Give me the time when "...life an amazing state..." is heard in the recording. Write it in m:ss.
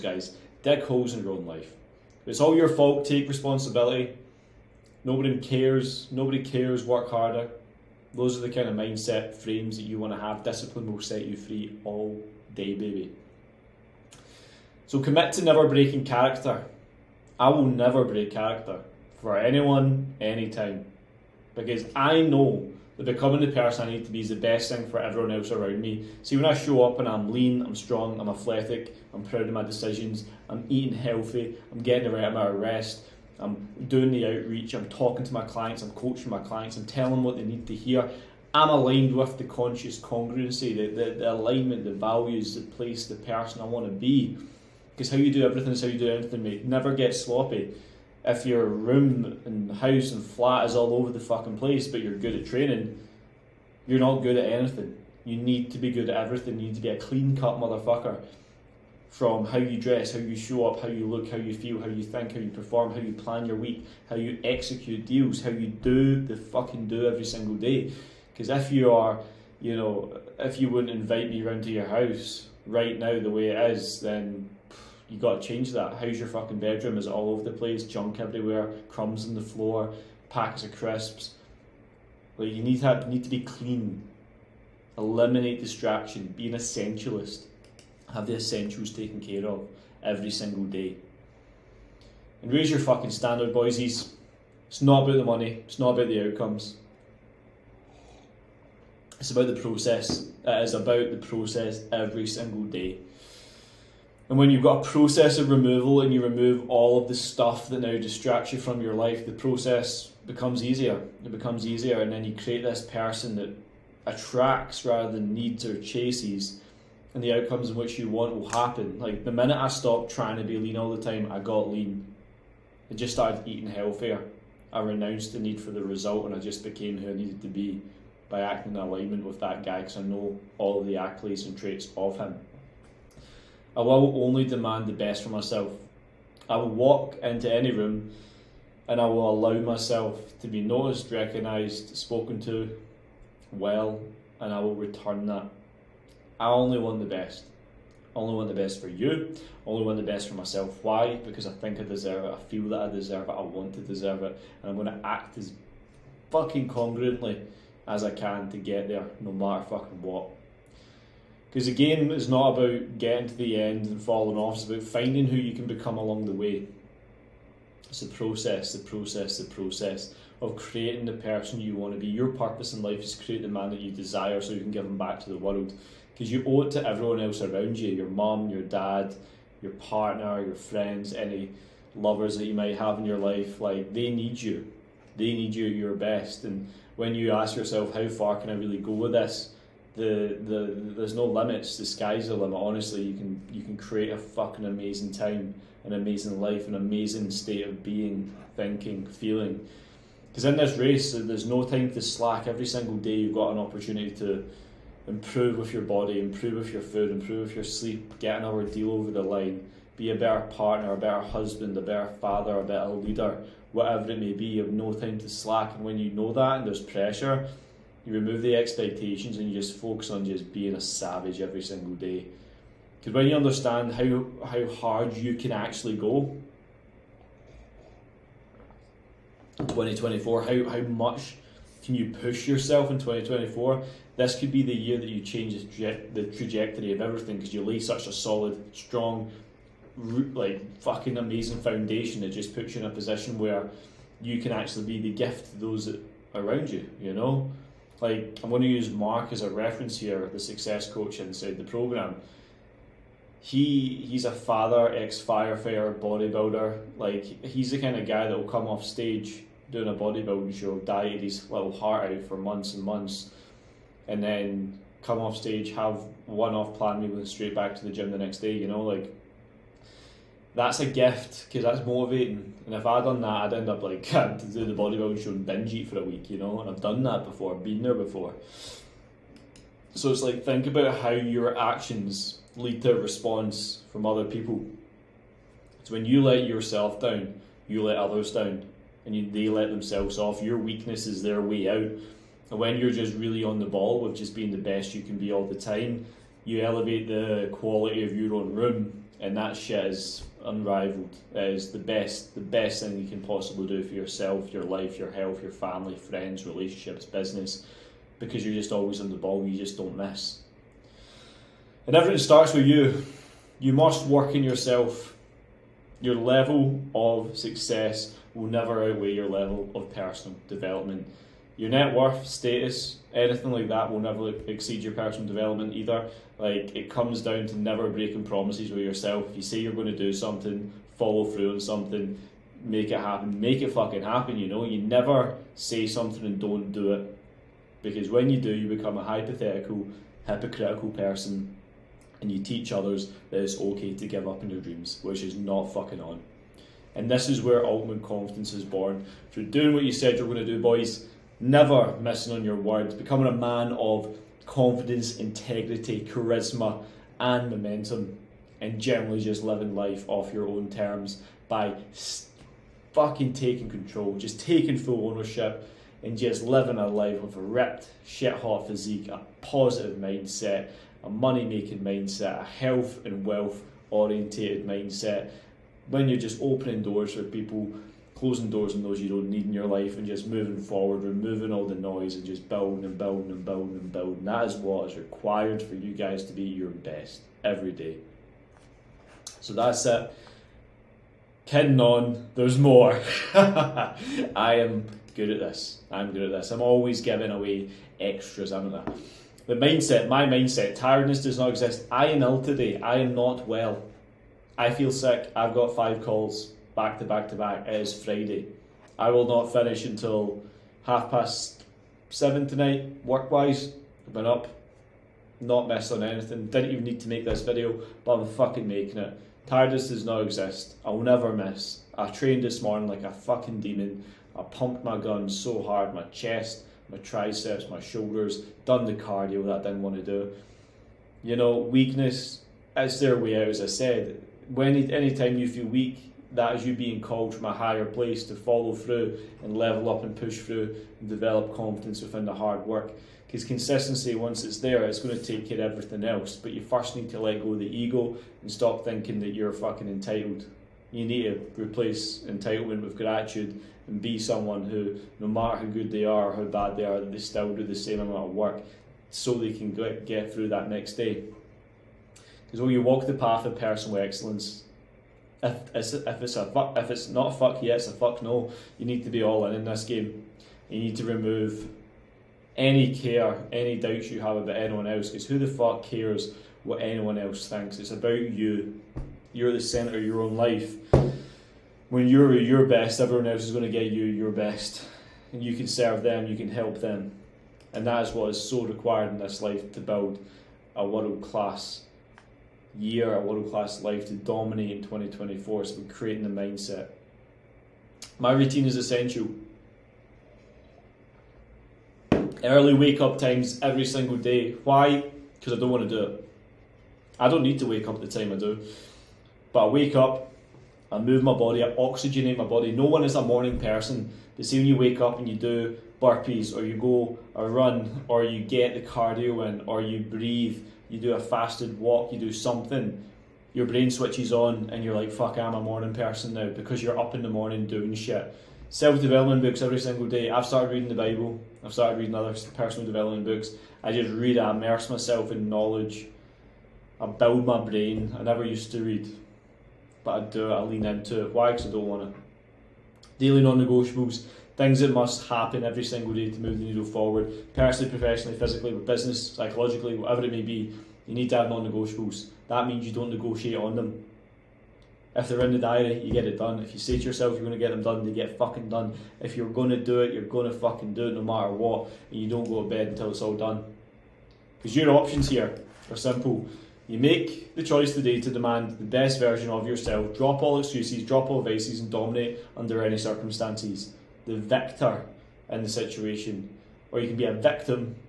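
3:16.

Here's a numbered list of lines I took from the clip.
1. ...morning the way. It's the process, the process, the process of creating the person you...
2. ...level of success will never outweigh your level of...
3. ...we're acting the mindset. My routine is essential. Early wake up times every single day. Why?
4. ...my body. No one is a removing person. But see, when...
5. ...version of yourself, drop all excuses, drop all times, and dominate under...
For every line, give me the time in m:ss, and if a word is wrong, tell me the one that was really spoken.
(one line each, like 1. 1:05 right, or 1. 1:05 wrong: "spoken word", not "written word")
1. 2:45 wrong: "along", not "morning"
2. 5:16 right
3. 8:15 wrong: "creating", not "acting"
4. 8:32 wrong: "morning", not "removing"
5. 9:29 wrong: "vices", not "times".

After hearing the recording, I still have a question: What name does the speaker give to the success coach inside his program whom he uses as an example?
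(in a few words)
Mark.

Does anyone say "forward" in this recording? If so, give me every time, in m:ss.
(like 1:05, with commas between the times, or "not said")
6:20, 9:06.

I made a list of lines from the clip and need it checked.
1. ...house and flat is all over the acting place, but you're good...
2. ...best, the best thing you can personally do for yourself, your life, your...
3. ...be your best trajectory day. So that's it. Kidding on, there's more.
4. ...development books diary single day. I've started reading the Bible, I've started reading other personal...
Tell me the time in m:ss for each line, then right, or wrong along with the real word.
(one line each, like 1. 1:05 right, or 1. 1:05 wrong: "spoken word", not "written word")
1. 0:49 wrong: "fucking", not "acting"
2. 5:01 wrong: "possibly", not "personally"
3. 6:26 wrong: "every", not "trajectory"
4. 8:48 wrong: "every", not "diary".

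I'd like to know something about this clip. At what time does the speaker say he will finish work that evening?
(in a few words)
7:30.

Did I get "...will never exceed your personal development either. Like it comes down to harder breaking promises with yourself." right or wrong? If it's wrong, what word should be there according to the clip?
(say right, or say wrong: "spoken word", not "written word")
wrong: "never", not "harder".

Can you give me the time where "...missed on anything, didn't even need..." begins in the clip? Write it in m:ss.
6:55.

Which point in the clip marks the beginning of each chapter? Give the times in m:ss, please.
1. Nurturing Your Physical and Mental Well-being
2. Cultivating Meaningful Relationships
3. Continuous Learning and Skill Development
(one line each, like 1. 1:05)
1. 0:46
2. 4:11
3. 6:56.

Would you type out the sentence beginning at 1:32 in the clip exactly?
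And raise your fucking standard, boysies.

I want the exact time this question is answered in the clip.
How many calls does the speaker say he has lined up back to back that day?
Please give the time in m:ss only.
6:45.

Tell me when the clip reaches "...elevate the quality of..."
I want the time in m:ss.
4:56.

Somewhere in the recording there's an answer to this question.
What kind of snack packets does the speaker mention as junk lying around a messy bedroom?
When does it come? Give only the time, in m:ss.
1:20.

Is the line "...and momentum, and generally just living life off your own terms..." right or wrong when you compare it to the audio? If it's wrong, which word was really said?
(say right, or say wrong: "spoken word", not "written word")
right.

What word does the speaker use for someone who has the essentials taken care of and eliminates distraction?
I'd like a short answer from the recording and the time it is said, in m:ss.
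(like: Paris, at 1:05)
Essentialist, at 1:26.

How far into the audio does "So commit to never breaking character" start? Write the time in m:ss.
0:14.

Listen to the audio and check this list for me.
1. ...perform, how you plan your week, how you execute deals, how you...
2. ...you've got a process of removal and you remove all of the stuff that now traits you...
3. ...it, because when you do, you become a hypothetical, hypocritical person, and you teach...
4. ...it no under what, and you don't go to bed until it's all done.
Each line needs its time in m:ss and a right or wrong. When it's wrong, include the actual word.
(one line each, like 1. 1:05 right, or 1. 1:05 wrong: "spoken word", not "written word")
1. 1:02 right
2. 1:44 wrong: "distracts", not "traits"
3. 5:36 right
4. 9:21 wrong: "matter", not "under".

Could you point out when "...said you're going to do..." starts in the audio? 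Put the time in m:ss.
5:49.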